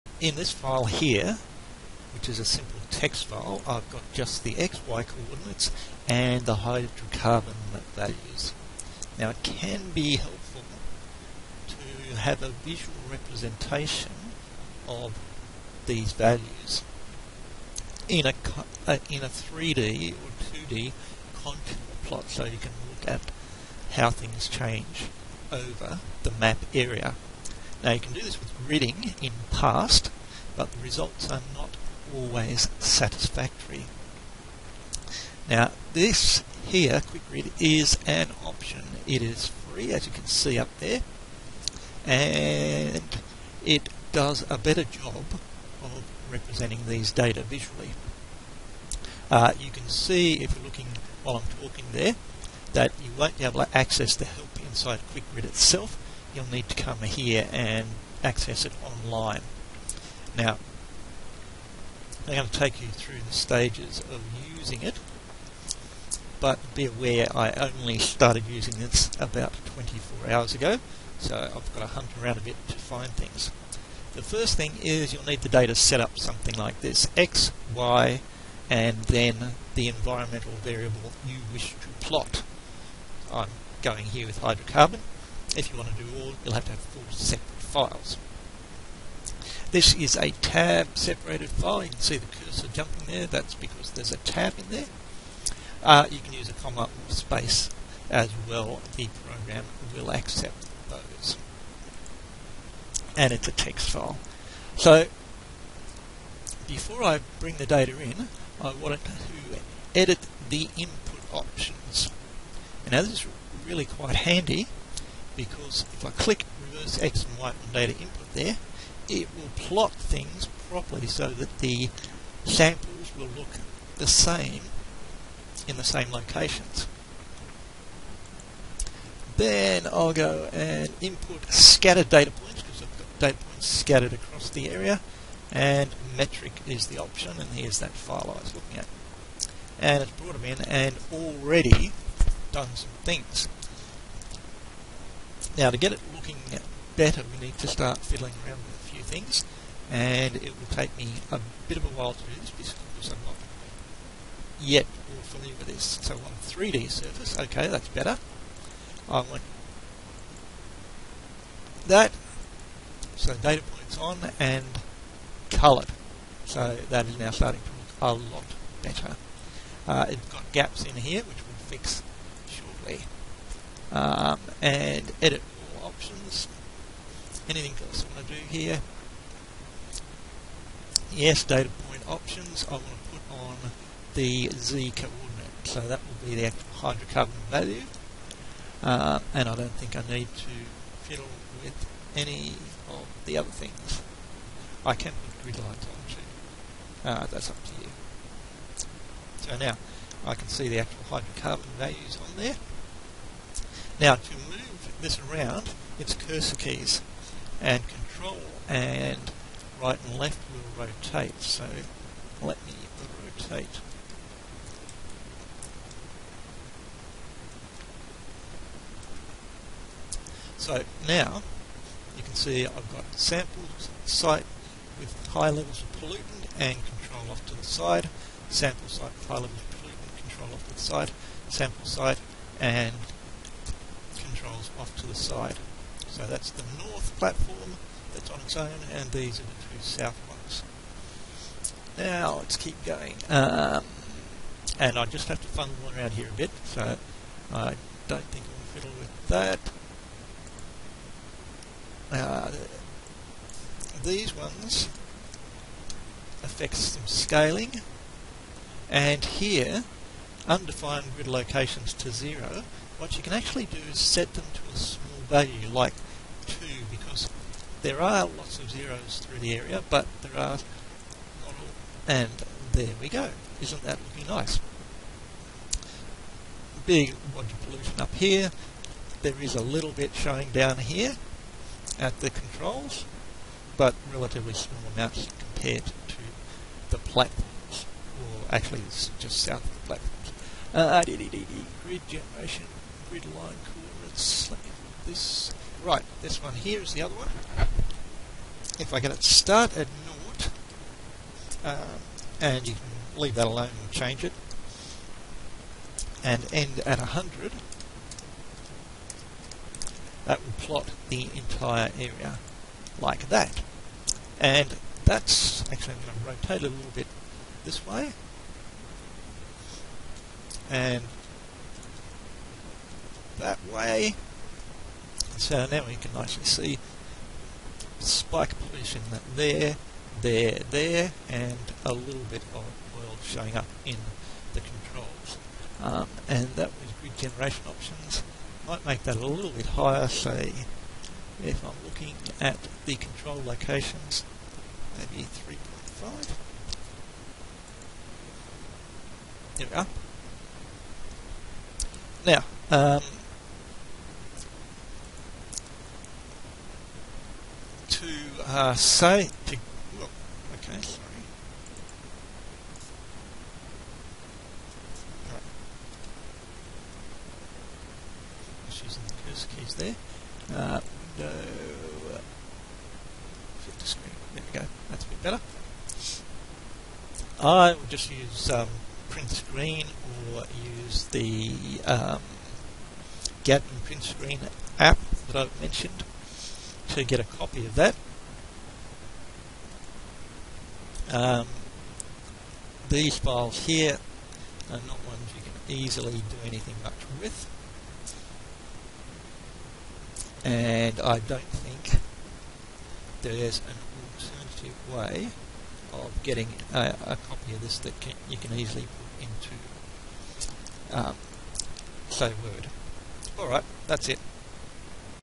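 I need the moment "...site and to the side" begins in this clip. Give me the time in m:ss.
3:51.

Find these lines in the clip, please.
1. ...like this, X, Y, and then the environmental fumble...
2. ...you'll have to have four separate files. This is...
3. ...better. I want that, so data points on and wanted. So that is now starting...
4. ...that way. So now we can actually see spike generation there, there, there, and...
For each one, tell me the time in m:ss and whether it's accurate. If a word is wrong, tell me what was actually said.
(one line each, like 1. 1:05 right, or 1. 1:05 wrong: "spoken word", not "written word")
1. 1:16 wrong: "variable", not "fumble"
2. 1:26 right
3. 2:37 wrong: "coloured", not "wanted"
4. 5:23 wrong: "pollution", not "generation".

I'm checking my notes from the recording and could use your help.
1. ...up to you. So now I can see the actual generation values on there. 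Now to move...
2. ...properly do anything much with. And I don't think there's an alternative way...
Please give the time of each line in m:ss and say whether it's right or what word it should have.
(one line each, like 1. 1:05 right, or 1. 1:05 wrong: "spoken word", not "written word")
1. 3:17 wrong: "hydrocarbon", not "generation"
2. 6:35 wrong: "easily", not "properly".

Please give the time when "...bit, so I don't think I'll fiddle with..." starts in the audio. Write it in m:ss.
4:06.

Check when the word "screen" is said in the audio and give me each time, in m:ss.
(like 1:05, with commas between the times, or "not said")
6:13, 6:19, 6:24.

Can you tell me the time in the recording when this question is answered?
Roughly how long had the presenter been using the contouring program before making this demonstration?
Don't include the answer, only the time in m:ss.
1:09.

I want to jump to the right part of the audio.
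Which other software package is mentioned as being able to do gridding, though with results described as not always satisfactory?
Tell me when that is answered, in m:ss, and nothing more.
0:29.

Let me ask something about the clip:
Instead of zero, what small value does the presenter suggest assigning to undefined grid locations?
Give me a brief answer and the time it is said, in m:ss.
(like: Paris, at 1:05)
2, at 4:26.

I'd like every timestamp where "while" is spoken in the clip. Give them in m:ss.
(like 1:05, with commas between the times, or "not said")
0:51, 2:31.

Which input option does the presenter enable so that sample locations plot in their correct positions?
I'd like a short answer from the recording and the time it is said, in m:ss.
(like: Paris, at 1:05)
reverse X and Y, at 1:56.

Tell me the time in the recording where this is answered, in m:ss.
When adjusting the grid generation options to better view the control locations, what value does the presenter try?
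5:45.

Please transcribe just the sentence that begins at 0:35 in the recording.
Now this here, quick is an option.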